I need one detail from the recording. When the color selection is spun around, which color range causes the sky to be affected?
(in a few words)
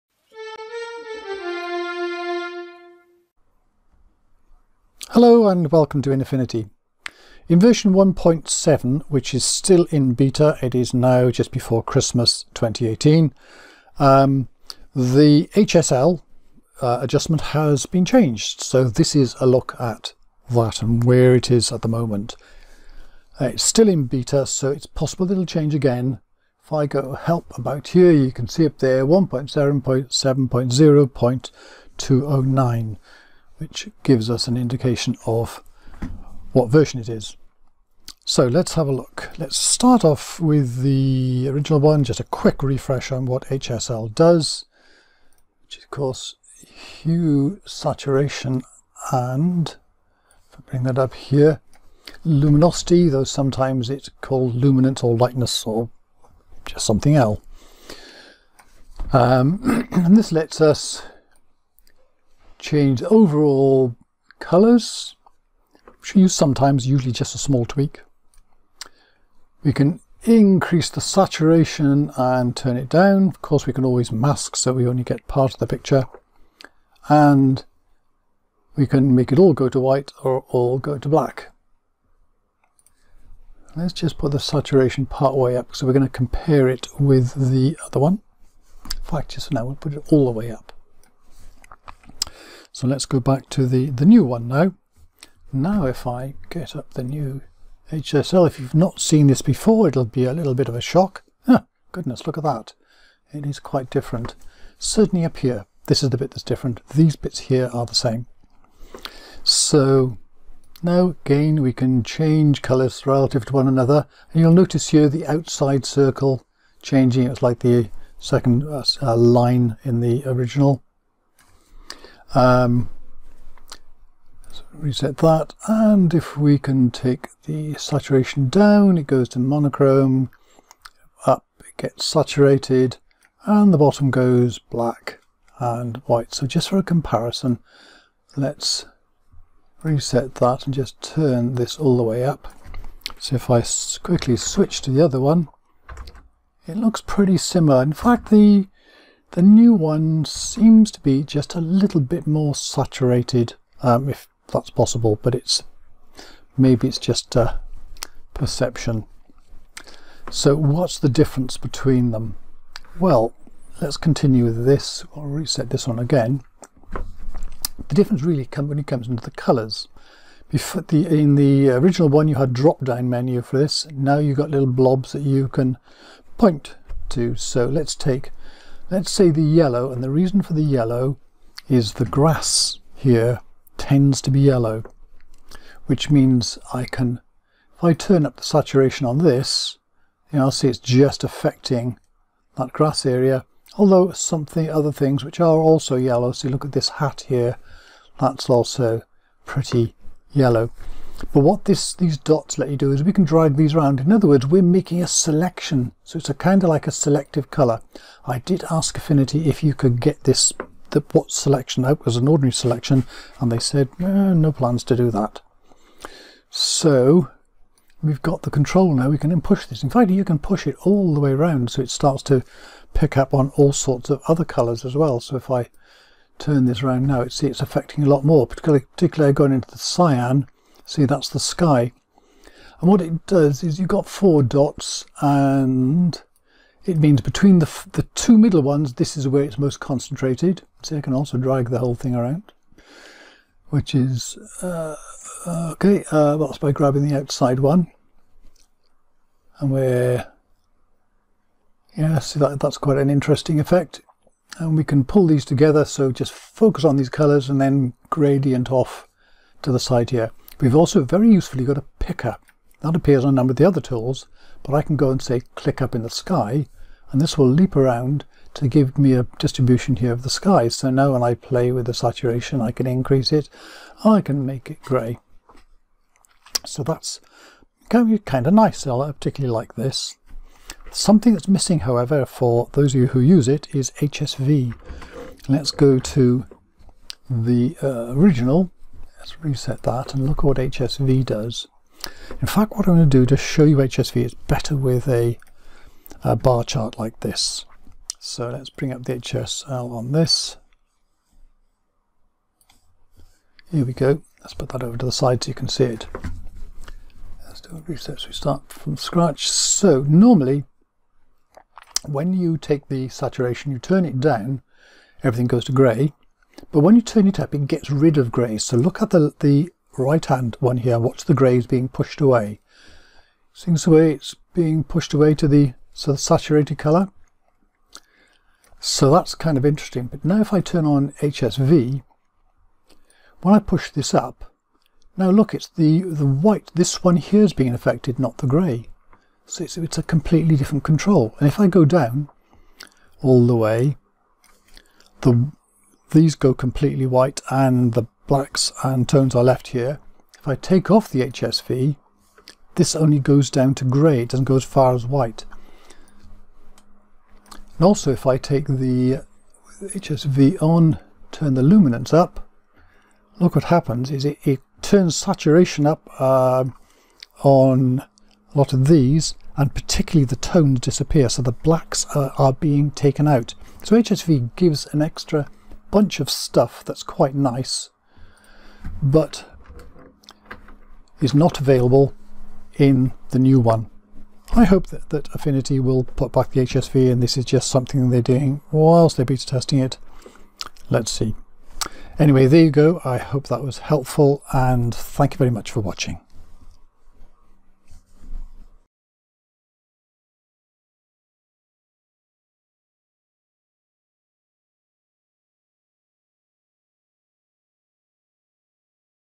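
Cyan.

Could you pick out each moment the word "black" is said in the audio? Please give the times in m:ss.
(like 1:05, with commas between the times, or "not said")
1:21, 2:14, 5:48, 6:11.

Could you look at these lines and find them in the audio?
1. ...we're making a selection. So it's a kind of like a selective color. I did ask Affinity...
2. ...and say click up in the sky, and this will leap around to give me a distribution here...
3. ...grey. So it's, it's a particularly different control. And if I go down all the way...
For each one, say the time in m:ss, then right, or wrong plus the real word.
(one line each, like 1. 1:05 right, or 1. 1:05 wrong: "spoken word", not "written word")
1. 3:24 right
2. 4:25 right
3. 5:38 wrong: "completely", not "particularly".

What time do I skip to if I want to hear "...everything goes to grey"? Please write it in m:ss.
5:15.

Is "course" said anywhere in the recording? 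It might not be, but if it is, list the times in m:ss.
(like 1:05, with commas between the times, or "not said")
0:45, 1:13.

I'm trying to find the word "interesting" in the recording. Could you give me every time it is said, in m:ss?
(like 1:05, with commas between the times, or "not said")
4:13, 5:29.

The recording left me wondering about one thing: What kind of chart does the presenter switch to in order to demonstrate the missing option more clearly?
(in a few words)
A bar chart.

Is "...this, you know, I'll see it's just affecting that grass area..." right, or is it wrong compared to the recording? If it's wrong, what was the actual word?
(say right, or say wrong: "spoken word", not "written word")
right.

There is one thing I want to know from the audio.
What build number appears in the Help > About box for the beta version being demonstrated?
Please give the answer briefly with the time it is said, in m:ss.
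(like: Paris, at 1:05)
1.7.0.209, at 0:29.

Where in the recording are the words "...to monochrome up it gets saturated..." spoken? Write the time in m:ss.
2:09.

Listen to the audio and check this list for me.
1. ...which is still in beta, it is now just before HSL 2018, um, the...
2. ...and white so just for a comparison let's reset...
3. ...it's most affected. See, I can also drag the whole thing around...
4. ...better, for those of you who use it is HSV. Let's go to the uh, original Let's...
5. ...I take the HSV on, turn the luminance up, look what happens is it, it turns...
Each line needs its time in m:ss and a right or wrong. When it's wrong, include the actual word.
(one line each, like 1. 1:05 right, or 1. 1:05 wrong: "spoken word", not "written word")
1. 0:09 wrong: "Christmas", not "HSL"
2. 2:15 right
3. 3:59 wrong: "concentrated", not "affected"
4. 4:41 wrong: "however", not "better"
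5. 5:58 right.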